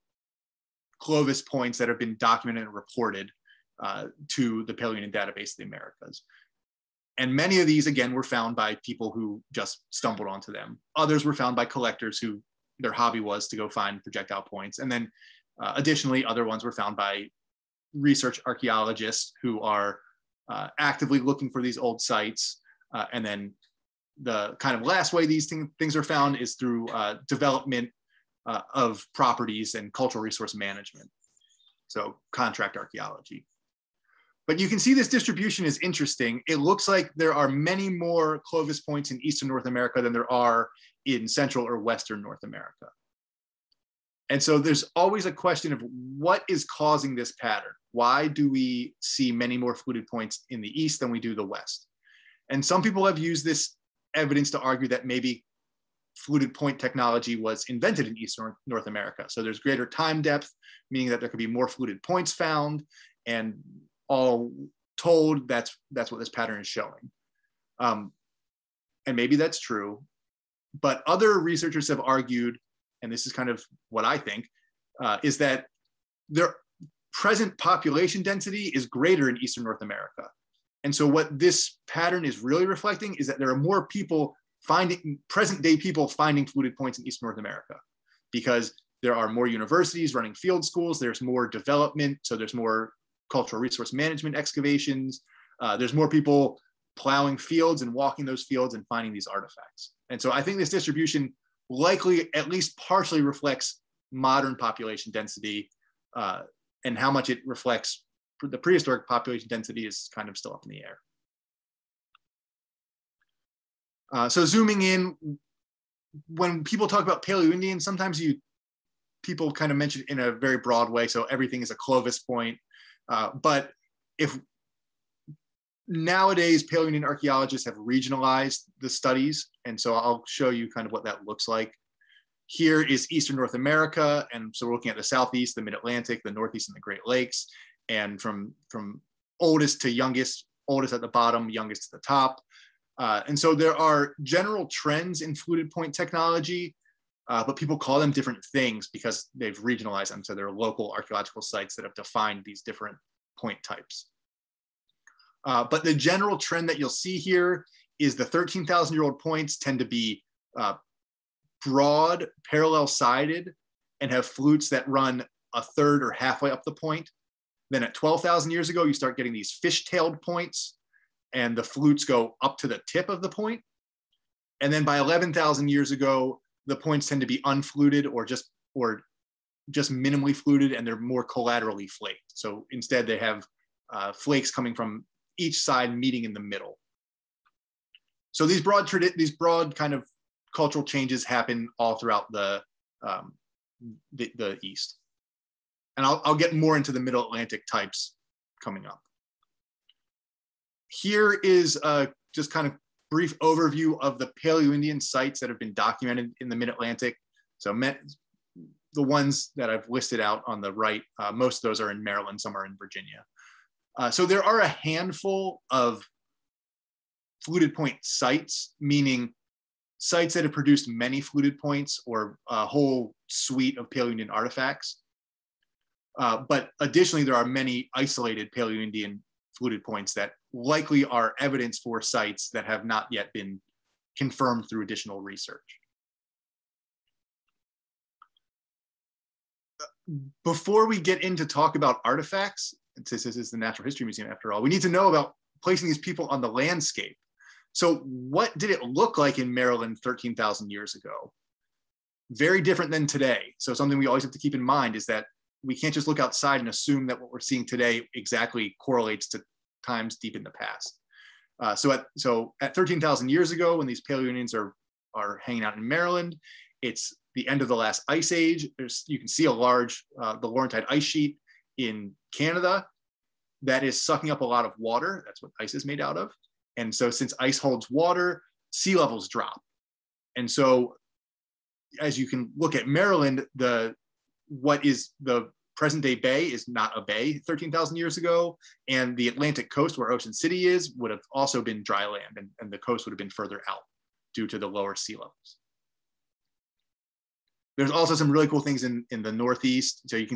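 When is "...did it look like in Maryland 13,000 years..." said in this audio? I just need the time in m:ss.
4:08.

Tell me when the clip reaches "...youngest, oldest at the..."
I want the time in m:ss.
2:19.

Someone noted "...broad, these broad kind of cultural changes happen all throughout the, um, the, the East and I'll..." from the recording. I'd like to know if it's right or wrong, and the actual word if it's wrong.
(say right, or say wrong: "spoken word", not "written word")
right.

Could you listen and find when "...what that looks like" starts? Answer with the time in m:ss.
2:10.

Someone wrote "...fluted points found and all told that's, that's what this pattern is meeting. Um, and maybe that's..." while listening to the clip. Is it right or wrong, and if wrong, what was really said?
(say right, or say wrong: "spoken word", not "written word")
wrong: "showing", not "meeting".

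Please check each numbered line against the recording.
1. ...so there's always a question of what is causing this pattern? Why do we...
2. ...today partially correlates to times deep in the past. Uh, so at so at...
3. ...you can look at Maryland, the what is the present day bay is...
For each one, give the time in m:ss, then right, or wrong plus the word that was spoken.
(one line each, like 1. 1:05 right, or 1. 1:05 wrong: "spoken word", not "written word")
1. 0:44 right
2. 4:17 wrong: "exactly", not "partially"
3. 4:42 right.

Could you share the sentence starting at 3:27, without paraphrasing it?
So, the ones that I've listed out on the right, uh, most of those are in Maryland, some are in Virginia.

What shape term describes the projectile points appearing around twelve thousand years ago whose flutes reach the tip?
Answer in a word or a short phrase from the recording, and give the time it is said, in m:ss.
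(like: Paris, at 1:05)
fish-tailed, at 2:49.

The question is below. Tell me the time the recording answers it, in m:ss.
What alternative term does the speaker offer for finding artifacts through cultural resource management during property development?
0:32.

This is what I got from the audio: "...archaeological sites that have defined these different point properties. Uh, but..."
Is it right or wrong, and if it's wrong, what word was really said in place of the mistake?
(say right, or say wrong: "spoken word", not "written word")
wrong: "types", not "properties".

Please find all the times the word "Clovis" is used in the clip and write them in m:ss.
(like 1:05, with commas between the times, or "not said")
0:00, 0:38, 2:01.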